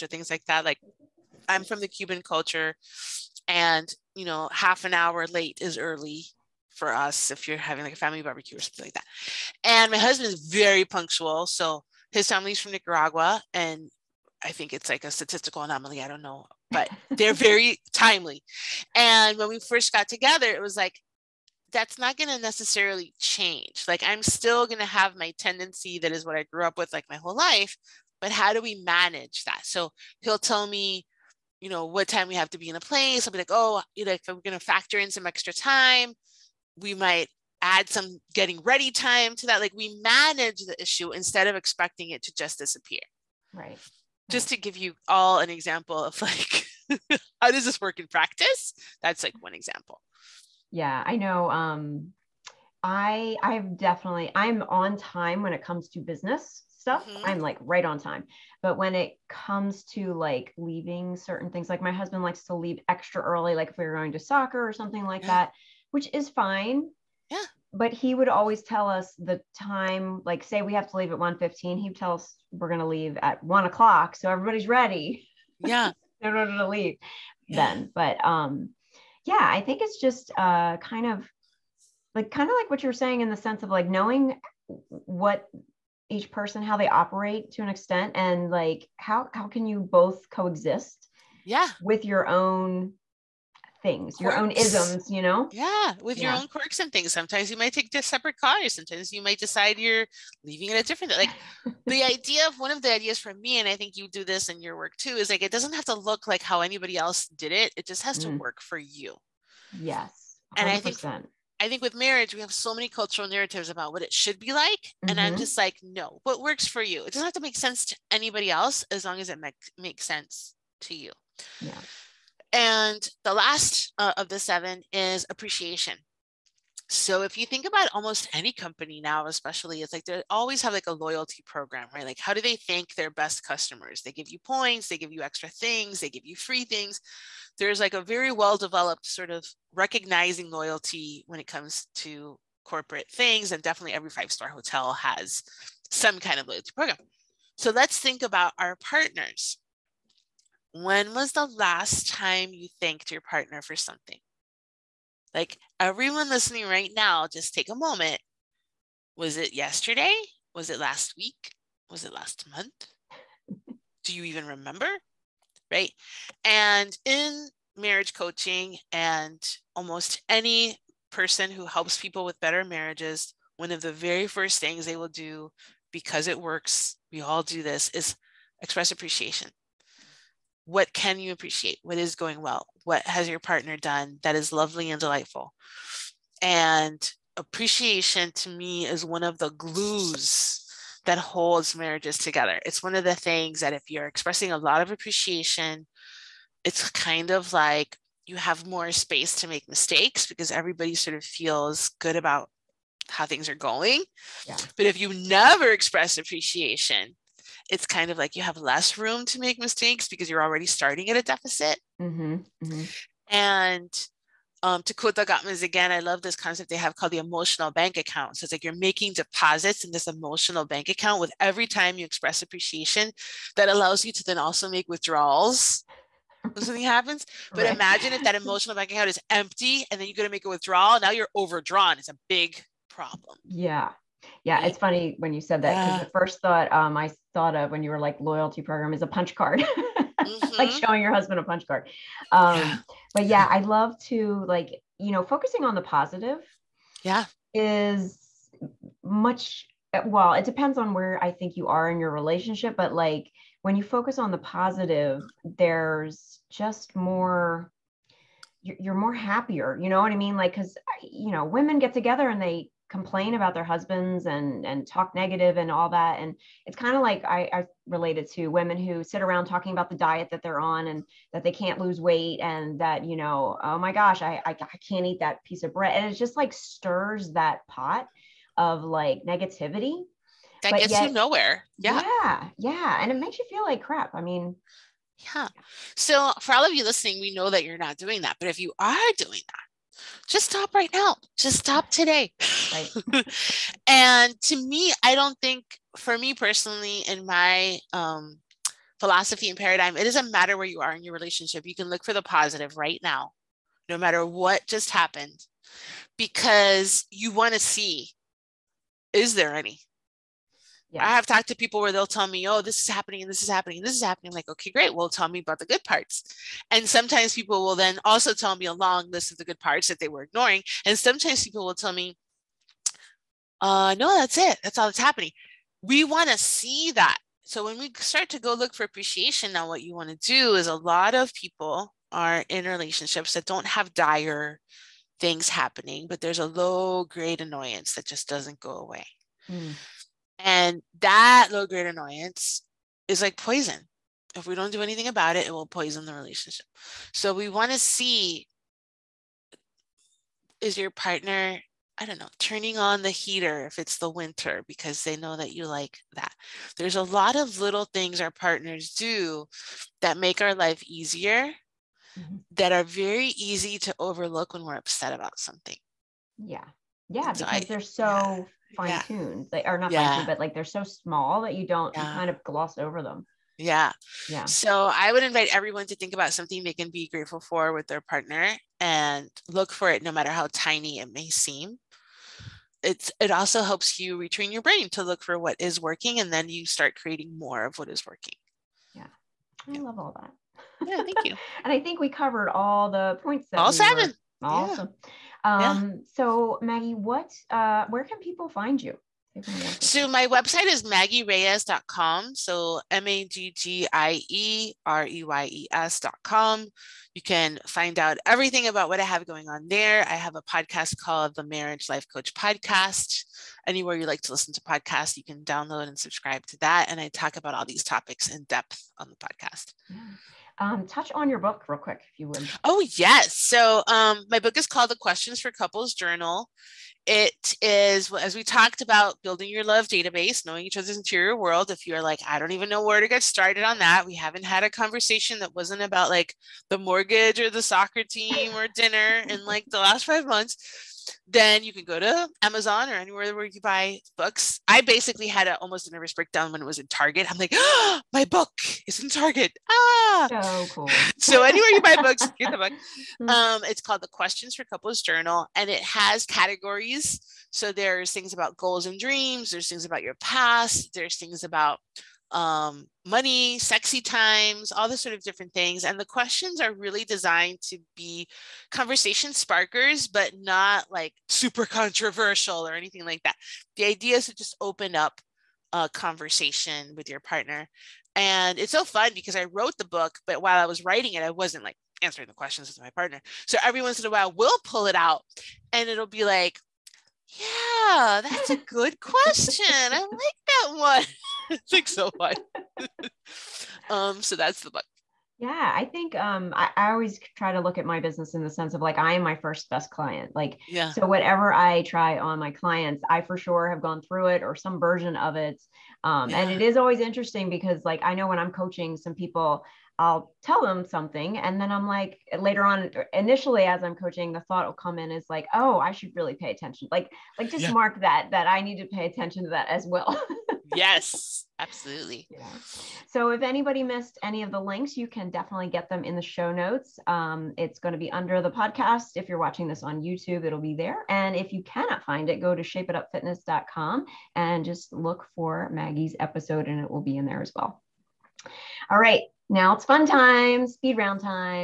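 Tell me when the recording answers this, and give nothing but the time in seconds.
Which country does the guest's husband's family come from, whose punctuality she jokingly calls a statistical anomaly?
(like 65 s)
12 s.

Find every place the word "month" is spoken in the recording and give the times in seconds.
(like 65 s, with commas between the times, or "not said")
162 s, 440 s.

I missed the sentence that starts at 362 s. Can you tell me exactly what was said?
that are very easy to overlook when we're upset about something.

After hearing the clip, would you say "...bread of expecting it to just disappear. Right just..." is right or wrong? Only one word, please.
wrong.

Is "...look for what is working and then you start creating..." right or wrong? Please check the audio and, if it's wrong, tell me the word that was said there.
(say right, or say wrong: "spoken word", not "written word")
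right.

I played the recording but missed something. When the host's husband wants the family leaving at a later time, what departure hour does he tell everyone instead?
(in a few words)
1 o'clock.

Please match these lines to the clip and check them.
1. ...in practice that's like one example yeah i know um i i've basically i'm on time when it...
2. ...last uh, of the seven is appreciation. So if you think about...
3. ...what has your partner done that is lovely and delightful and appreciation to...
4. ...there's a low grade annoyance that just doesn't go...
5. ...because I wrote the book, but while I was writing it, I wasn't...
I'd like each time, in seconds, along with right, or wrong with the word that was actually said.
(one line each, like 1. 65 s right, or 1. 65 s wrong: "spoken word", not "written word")
1. 47 s wrong: "definitely", not "basically"
2. 123 s right
3. 182 s right
4. 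336 s right
5. 479 s right.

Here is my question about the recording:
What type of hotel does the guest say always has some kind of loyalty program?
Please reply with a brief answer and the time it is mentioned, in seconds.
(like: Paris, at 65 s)
five star hotel, at 144 s.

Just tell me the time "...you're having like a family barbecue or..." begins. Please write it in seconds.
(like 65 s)
7 s.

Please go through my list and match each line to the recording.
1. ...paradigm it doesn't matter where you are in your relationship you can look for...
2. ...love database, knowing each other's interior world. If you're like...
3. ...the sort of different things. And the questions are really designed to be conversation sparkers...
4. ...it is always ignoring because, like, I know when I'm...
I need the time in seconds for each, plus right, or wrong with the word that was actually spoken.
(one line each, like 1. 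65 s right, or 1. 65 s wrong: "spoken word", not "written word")
1. 299 s right
2. 429 s right
3. 464 s right
4. 506 s wrong: "interesting", not "ignoring".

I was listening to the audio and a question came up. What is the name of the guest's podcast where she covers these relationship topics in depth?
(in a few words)
Marriage Life Coach Podcast.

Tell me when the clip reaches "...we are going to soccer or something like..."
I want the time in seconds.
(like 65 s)
63 s.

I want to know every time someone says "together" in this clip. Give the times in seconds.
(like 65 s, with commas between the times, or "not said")
20 s, 192 s, 261 s.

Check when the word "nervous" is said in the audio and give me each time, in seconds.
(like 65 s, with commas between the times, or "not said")
445 s.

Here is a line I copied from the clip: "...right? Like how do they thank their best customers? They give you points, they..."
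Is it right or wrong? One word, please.
right.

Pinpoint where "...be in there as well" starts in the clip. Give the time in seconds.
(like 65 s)
537 s.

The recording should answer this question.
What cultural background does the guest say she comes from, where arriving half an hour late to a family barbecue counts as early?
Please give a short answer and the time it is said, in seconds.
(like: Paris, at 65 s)
Cuban, at 1 s.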